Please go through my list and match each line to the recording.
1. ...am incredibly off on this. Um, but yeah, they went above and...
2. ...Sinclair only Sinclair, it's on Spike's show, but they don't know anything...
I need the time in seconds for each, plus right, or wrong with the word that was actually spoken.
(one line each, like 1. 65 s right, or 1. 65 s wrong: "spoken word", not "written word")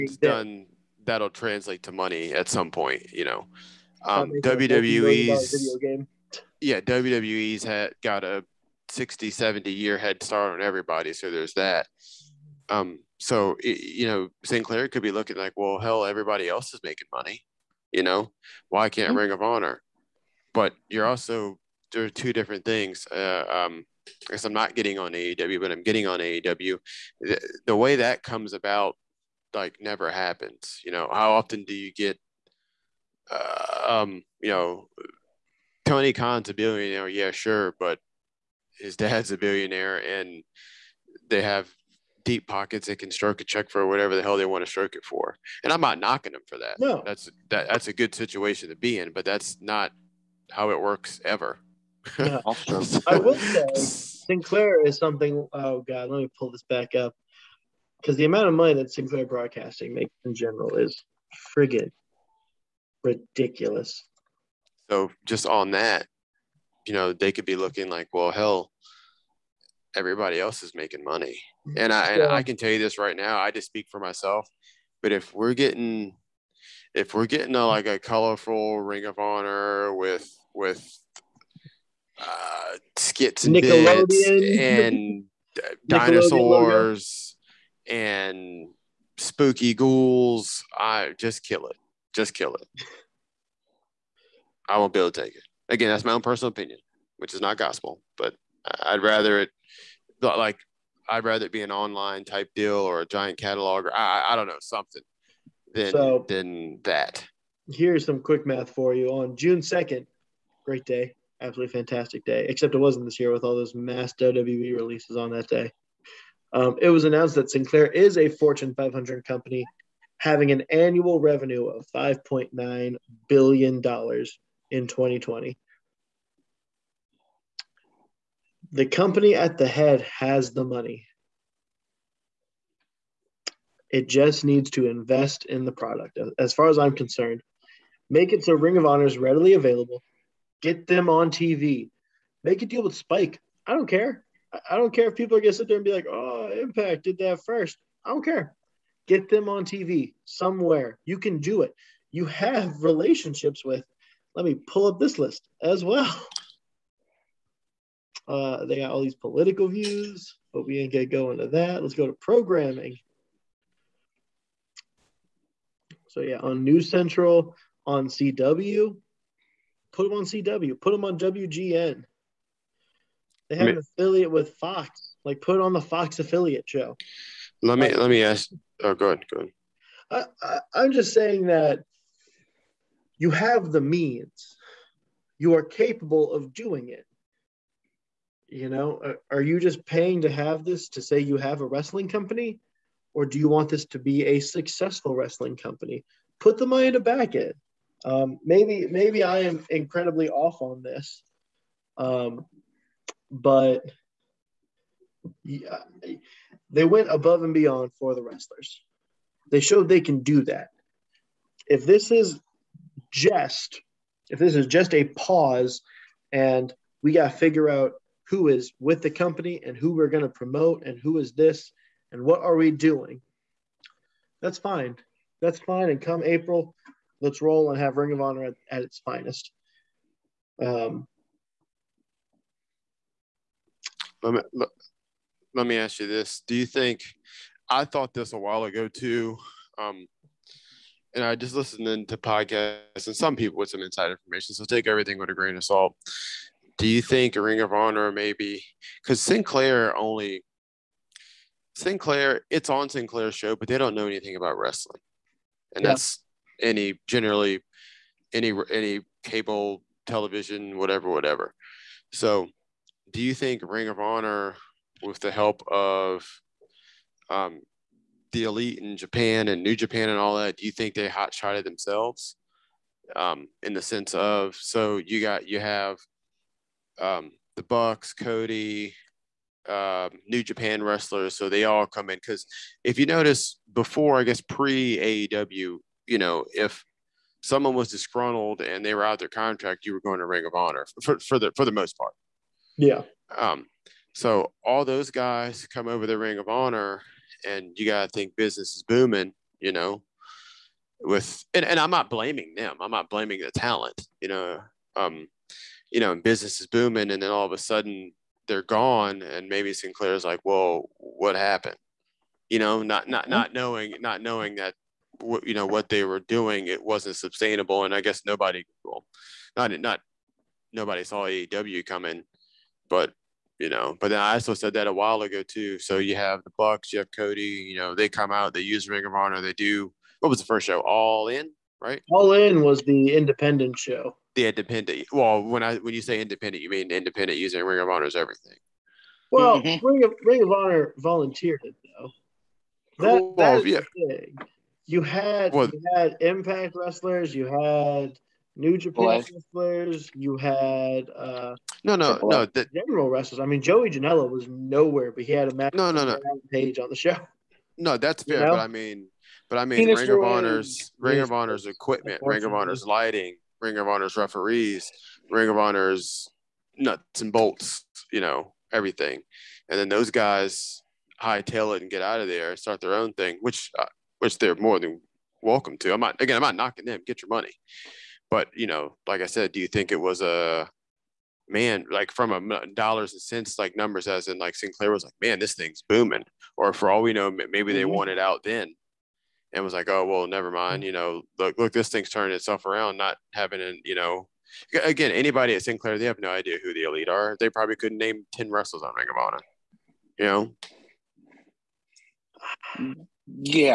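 1. 199 s right
2. 249 s wrong: "Sinclair", not "Spike".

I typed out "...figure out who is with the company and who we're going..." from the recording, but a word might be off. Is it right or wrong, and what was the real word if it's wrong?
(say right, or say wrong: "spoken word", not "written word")
right.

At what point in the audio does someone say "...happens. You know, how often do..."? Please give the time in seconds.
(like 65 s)
30 s.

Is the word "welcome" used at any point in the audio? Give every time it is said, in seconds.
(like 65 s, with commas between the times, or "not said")
375 s.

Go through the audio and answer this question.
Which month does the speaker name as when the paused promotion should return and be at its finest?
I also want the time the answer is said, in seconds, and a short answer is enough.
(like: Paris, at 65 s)
April, at 226 s.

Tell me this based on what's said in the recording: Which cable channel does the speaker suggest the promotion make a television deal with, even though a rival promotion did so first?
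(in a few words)
Spike.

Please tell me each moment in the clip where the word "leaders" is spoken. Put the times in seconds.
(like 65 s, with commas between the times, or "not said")
not said.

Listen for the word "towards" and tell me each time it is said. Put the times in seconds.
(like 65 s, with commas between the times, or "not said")
not said.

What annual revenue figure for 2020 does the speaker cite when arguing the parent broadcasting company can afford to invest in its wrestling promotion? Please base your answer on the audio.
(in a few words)
$5.9 billion.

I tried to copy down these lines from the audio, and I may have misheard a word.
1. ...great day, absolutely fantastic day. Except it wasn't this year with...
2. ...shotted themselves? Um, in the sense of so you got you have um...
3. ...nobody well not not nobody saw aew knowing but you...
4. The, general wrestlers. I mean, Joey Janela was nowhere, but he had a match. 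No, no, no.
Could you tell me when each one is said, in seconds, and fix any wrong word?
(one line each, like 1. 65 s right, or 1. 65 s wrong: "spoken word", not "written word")
1. 110 s right
2. 271 s right
3. 318 s wrong: "coming", not "knowing"
4. 352 s right.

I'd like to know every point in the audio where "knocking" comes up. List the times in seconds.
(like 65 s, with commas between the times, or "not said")
45 s, 376 s.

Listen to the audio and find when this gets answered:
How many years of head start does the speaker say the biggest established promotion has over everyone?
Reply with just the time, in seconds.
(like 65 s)
8 s.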